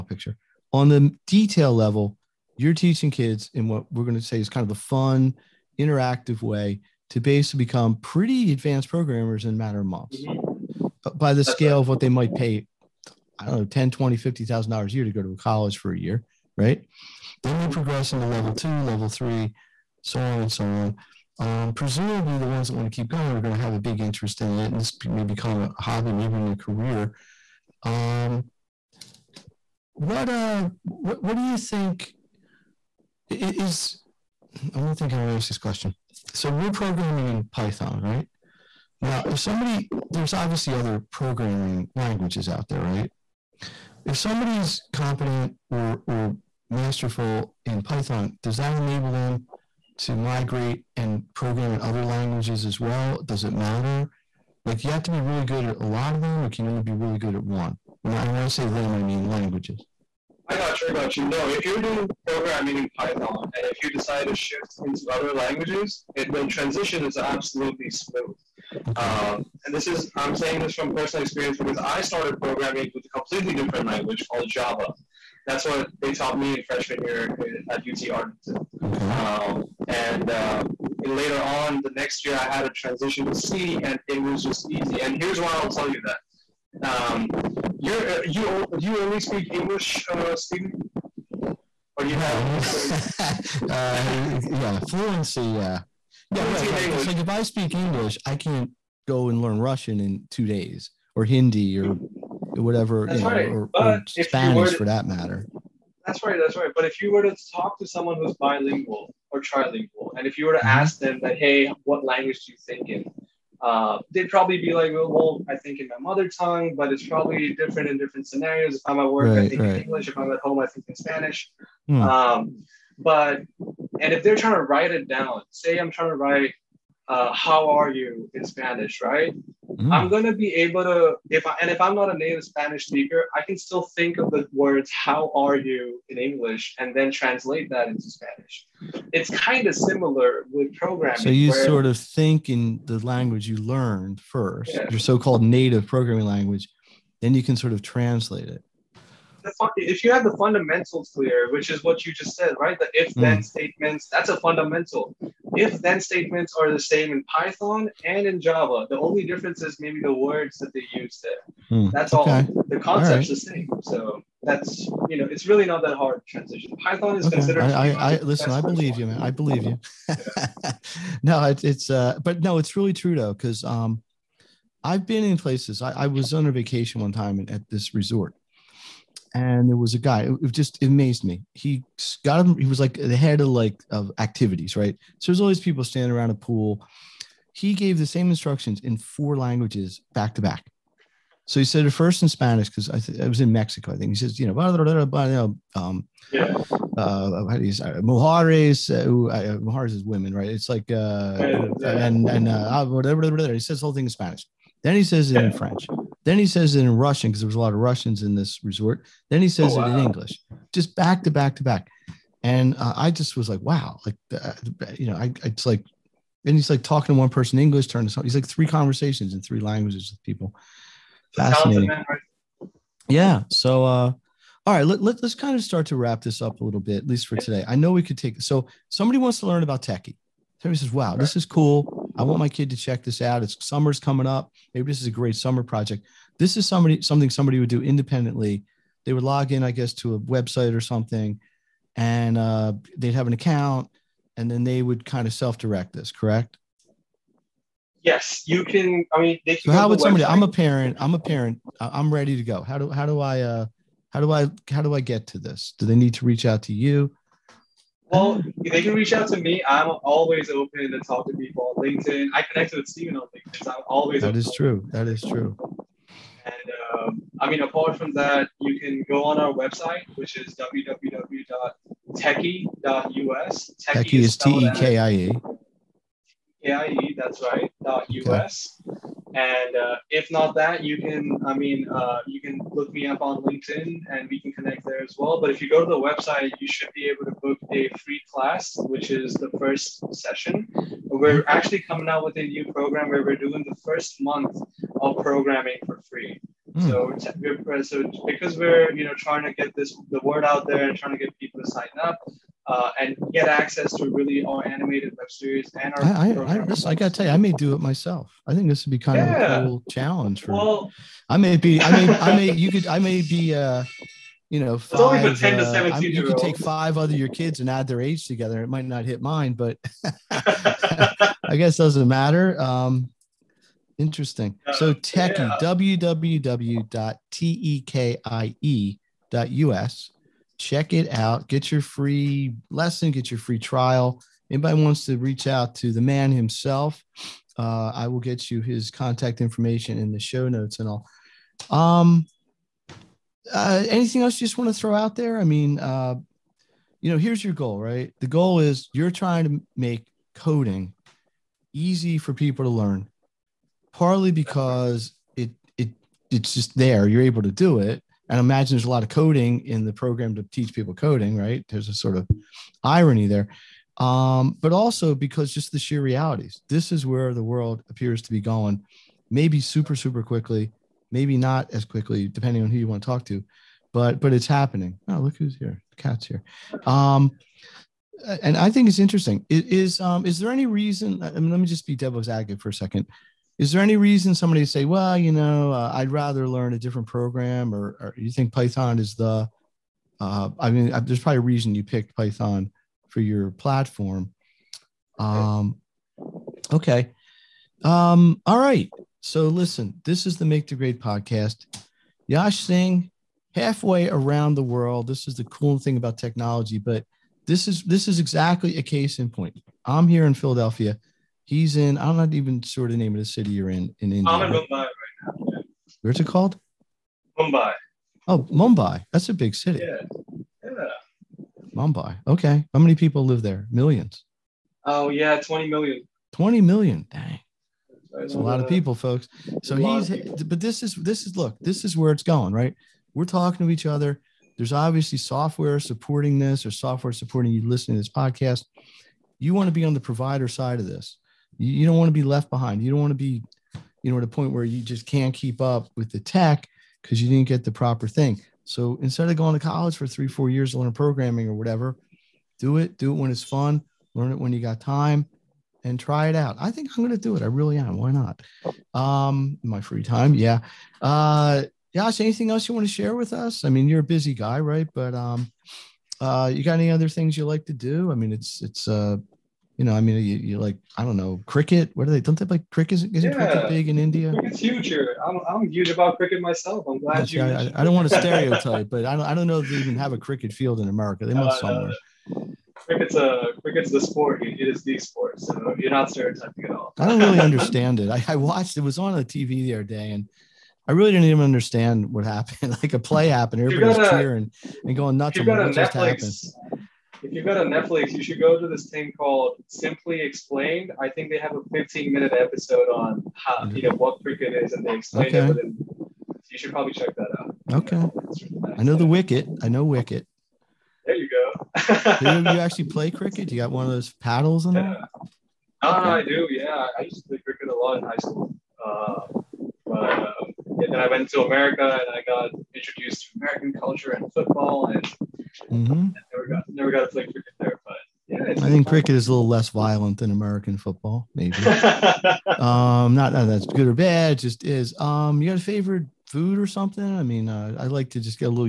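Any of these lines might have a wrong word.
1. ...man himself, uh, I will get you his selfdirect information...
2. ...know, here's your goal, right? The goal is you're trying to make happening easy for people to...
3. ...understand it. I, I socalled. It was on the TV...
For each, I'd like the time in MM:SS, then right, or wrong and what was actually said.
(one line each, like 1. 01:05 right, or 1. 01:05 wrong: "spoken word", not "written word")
1. 05:36 wrong: "contact", not "selfdirect"
2. 05:47 wrong: "coding", not "happening"
3. 08:07 wrong: "watched", not "socalled".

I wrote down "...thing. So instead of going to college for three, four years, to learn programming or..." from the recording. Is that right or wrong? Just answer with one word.
right.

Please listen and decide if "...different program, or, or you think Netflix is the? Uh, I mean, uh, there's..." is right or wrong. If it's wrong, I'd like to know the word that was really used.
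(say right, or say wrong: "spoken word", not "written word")
wrong: "Python", not "Netflix".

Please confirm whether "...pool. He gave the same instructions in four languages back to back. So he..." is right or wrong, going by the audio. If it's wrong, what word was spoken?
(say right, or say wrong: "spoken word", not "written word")
right.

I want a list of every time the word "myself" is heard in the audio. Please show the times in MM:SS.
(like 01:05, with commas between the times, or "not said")
05:07, 07:56.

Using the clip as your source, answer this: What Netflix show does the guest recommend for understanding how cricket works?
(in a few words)
Simply Explained.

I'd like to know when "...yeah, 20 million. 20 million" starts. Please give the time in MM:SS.
07:05.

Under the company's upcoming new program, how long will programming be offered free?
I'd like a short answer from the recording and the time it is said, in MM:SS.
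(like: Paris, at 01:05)
First month, at 04:53.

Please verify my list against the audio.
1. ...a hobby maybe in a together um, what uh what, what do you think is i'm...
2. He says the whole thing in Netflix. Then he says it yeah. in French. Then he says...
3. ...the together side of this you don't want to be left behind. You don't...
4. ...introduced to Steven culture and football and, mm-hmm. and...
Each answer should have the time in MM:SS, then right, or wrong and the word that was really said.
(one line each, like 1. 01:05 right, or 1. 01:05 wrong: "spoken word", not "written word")
1. 00:25 wrong: "career", not "together"
2. 03:23 wrong: "Spanish", not "Netflix"
3. 07:19 wrong: "provider", not "together"
4. 08:42 wrong: "American", not "Steven".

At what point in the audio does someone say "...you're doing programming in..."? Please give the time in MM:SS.
01:01.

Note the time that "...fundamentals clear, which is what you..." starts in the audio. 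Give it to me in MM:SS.
02:30.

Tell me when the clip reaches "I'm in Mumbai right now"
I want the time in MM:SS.
06:54.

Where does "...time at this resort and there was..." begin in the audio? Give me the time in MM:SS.
02:57.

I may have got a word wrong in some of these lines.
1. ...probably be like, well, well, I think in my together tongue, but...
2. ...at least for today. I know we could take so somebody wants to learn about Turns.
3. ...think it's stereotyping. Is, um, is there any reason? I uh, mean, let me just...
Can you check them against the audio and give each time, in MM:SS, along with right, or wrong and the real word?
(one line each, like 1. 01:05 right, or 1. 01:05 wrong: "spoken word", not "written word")
1. 01:54 wrong: "mother", not "together"
2. 03:46 wrong: "Tekie", not "Turns"
3. 06:18 wrong: "interesting", not "stereotyping".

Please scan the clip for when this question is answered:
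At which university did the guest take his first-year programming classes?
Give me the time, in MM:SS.
01:17.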